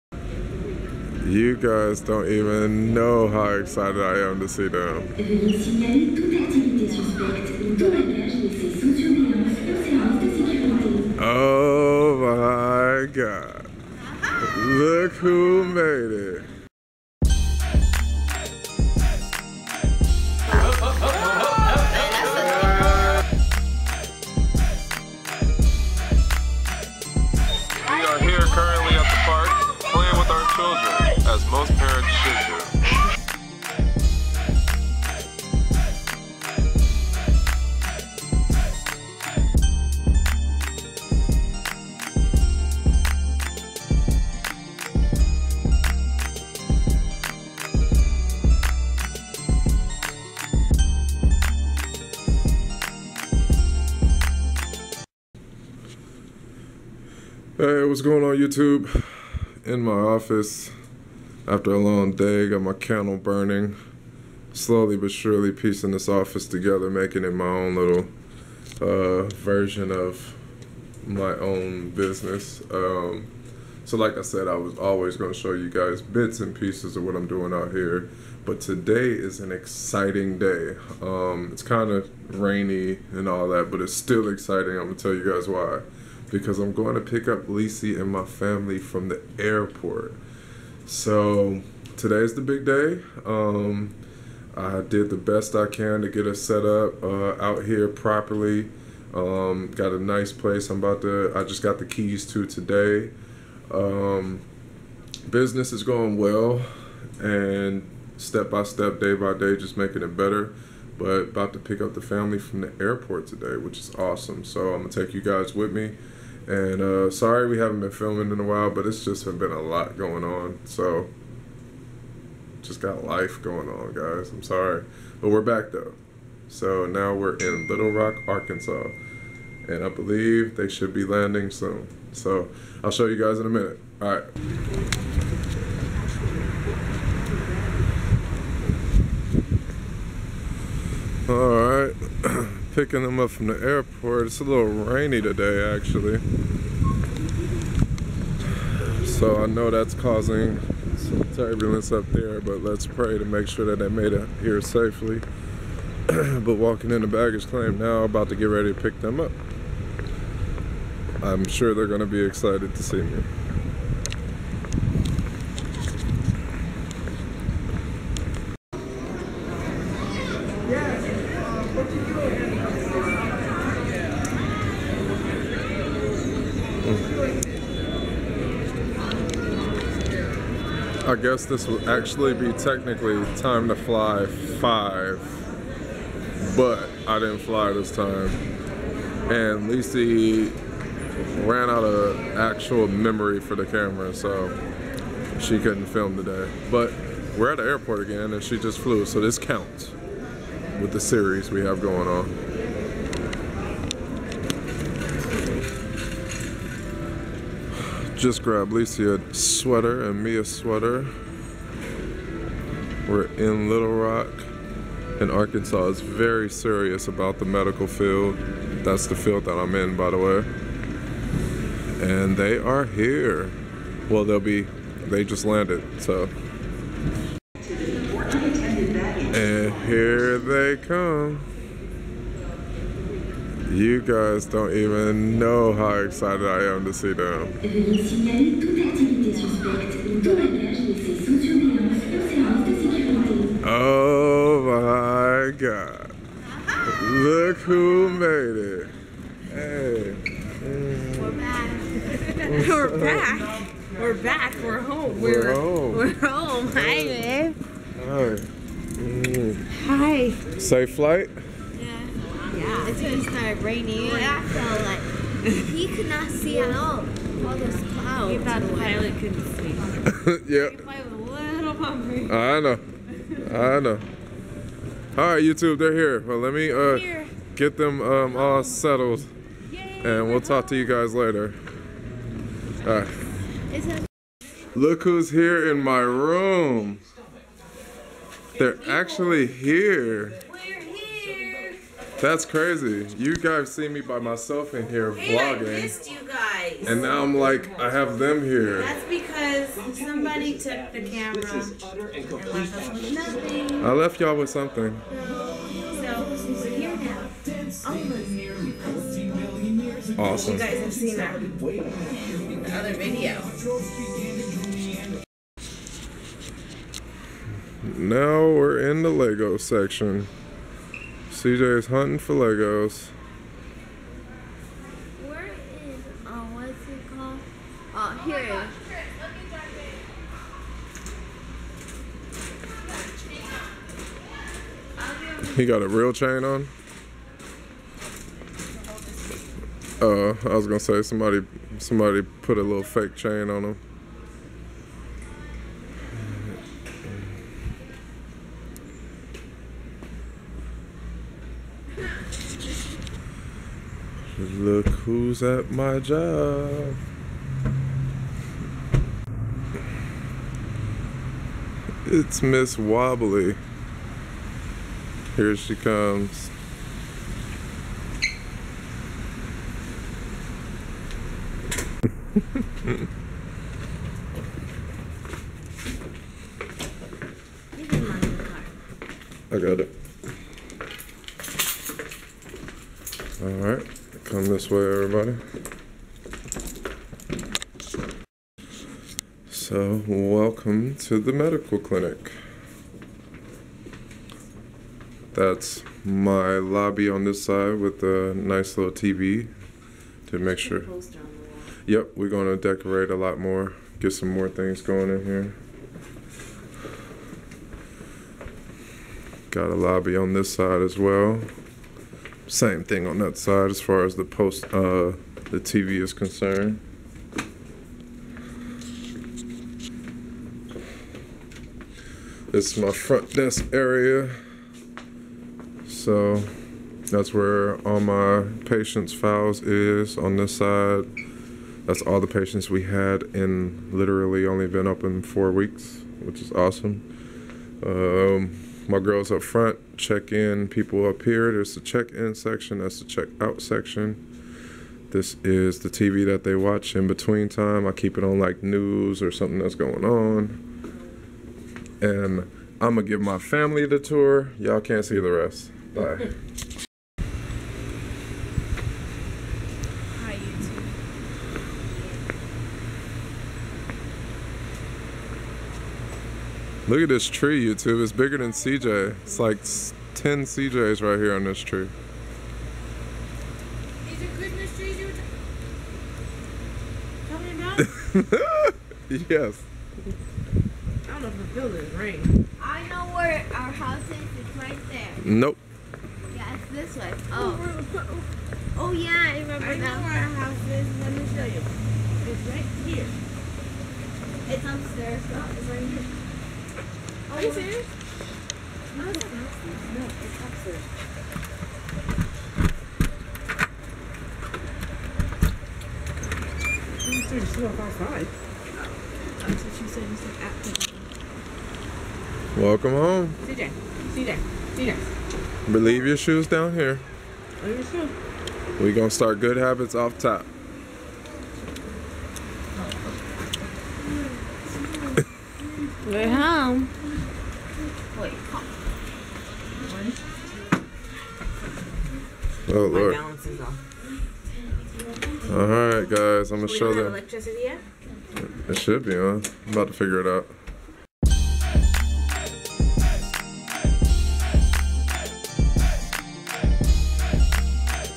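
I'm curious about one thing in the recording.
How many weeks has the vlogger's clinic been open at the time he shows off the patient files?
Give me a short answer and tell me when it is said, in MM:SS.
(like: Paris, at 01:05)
4, at 07:15.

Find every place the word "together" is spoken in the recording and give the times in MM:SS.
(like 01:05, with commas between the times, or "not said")
01:06.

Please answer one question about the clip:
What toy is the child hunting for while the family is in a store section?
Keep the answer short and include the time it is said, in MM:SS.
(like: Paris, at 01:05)
Legos, at 05:22.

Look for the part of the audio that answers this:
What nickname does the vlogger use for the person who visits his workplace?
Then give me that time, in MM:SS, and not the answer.
06:02.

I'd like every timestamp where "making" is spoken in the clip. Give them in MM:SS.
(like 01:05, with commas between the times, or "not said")
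01:06, 01:49.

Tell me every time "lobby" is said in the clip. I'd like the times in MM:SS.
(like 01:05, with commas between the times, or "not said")
06:36, 06:49.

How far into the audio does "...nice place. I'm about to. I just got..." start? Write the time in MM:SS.
01:39.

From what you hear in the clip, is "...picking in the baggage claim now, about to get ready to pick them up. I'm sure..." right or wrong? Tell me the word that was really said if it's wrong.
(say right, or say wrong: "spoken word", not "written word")
wrong: "walking", not "picking".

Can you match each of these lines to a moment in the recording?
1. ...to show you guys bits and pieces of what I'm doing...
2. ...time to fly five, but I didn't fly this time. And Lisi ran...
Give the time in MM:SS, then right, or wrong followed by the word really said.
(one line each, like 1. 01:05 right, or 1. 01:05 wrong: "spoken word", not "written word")
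1. 01:15 right
2. 03:03 right.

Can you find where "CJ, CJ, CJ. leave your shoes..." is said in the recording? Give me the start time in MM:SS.
08:33.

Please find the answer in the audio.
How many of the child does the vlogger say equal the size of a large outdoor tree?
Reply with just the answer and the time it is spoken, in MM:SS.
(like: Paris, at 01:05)
10, at 07:50.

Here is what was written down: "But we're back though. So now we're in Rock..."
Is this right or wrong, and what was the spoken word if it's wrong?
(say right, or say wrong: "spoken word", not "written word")
wrong: "Little", not "Rock".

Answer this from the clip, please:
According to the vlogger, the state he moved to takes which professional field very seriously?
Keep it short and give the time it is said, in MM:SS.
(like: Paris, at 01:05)
medical field, at 03:37.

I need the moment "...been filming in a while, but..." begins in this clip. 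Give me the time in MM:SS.
01:57.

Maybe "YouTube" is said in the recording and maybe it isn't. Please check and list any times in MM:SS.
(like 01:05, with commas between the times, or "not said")
00:58, 04:35, 07:47.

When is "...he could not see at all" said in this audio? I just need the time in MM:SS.
04:25.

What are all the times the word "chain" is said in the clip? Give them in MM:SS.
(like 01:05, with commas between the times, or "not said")
05:36, 05:43.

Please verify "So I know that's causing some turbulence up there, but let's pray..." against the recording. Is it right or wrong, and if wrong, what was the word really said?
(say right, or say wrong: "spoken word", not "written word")
right.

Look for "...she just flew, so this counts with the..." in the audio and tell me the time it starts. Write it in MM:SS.
03:18.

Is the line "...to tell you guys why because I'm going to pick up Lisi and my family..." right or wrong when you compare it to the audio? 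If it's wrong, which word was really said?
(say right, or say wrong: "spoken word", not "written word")
right.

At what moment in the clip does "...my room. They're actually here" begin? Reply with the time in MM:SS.
04:45.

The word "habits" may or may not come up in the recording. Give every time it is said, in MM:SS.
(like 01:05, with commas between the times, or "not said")
08:39.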